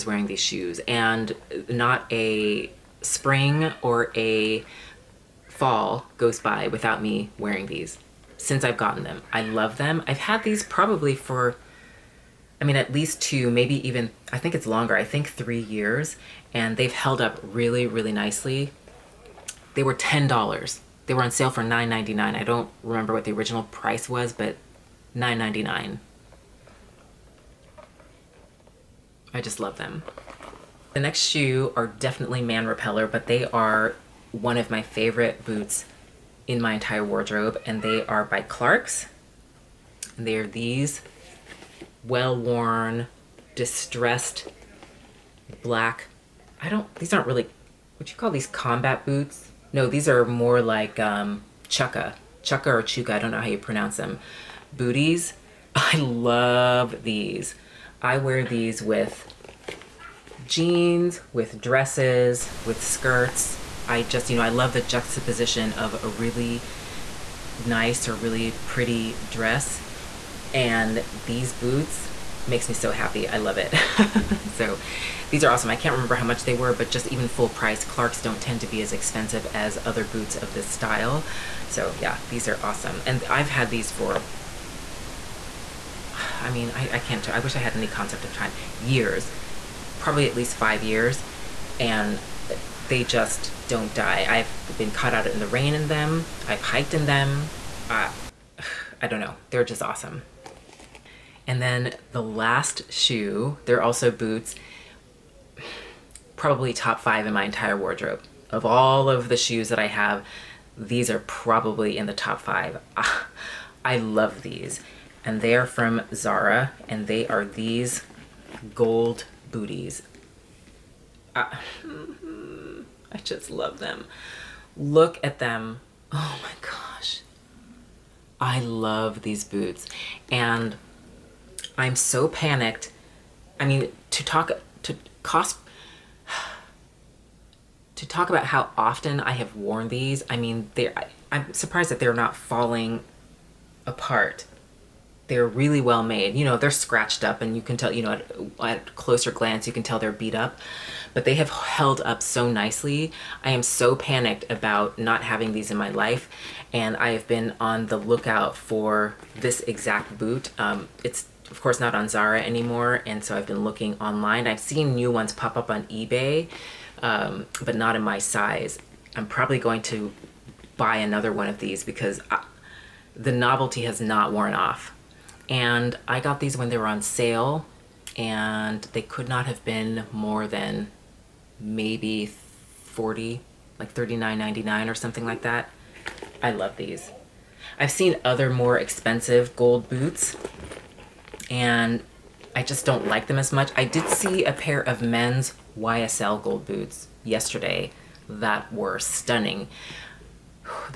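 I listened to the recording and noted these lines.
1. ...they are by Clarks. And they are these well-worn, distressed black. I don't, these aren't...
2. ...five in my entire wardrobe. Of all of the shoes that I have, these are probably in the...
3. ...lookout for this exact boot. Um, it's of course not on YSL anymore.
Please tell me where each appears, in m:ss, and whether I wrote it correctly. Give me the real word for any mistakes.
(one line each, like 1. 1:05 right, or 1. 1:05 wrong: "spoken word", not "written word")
1. 0:37 right
2. 1:46 right
3. 2:37 wrong: "Zara", not "YSL".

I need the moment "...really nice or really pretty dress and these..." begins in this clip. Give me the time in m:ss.
1:06.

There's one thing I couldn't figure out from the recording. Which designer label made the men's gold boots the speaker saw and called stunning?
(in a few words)
YSL.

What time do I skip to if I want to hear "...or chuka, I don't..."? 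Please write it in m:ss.
0:52.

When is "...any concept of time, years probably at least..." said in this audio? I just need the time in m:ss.
1:27.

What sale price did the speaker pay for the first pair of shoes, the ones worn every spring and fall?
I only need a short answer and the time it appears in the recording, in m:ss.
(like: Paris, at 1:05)
$9.99, at 0:21.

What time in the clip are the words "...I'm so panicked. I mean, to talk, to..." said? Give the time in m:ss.
2:11.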